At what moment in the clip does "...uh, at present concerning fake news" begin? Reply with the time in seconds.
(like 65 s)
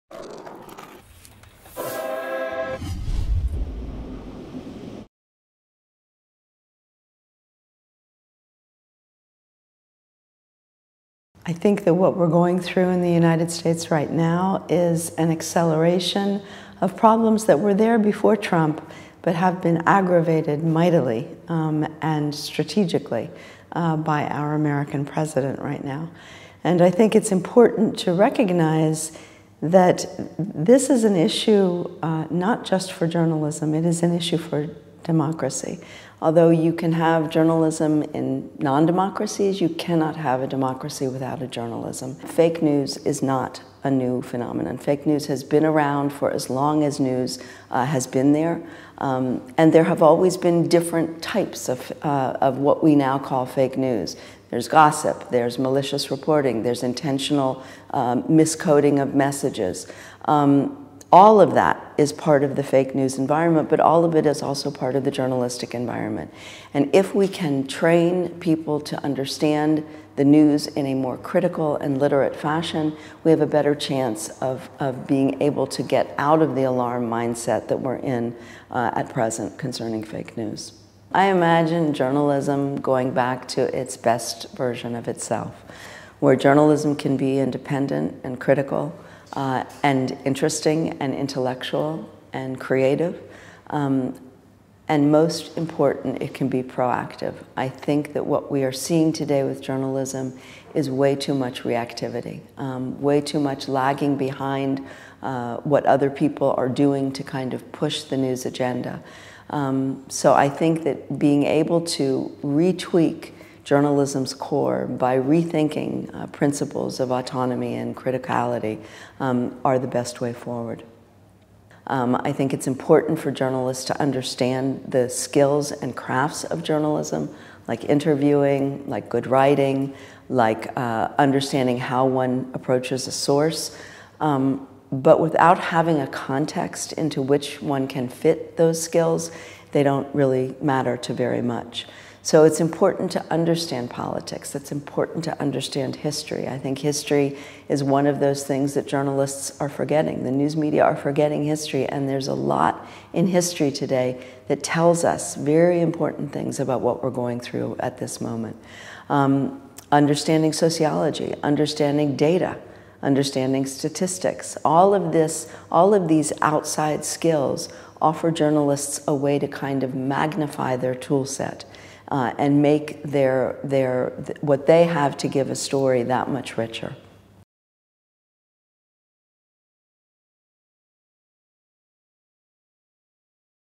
78 s.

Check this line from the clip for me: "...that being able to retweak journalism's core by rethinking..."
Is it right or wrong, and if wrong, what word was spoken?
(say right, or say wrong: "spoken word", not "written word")
right.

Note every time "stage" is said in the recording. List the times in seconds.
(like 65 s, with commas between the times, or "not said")
not said.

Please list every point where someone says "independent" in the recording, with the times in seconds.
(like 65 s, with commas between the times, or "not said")
87 s.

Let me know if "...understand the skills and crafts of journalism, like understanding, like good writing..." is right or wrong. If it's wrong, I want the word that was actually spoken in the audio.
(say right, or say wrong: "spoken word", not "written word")
wrong: "interviewing", not "understanding".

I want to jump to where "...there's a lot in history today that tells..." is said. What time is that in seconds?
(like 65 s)
152 s.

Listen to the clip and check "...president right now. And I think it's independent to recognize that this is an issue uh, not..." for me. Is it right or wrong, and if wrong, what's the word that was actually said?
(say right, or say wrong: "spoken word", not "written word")
wrong: "important", not "independent".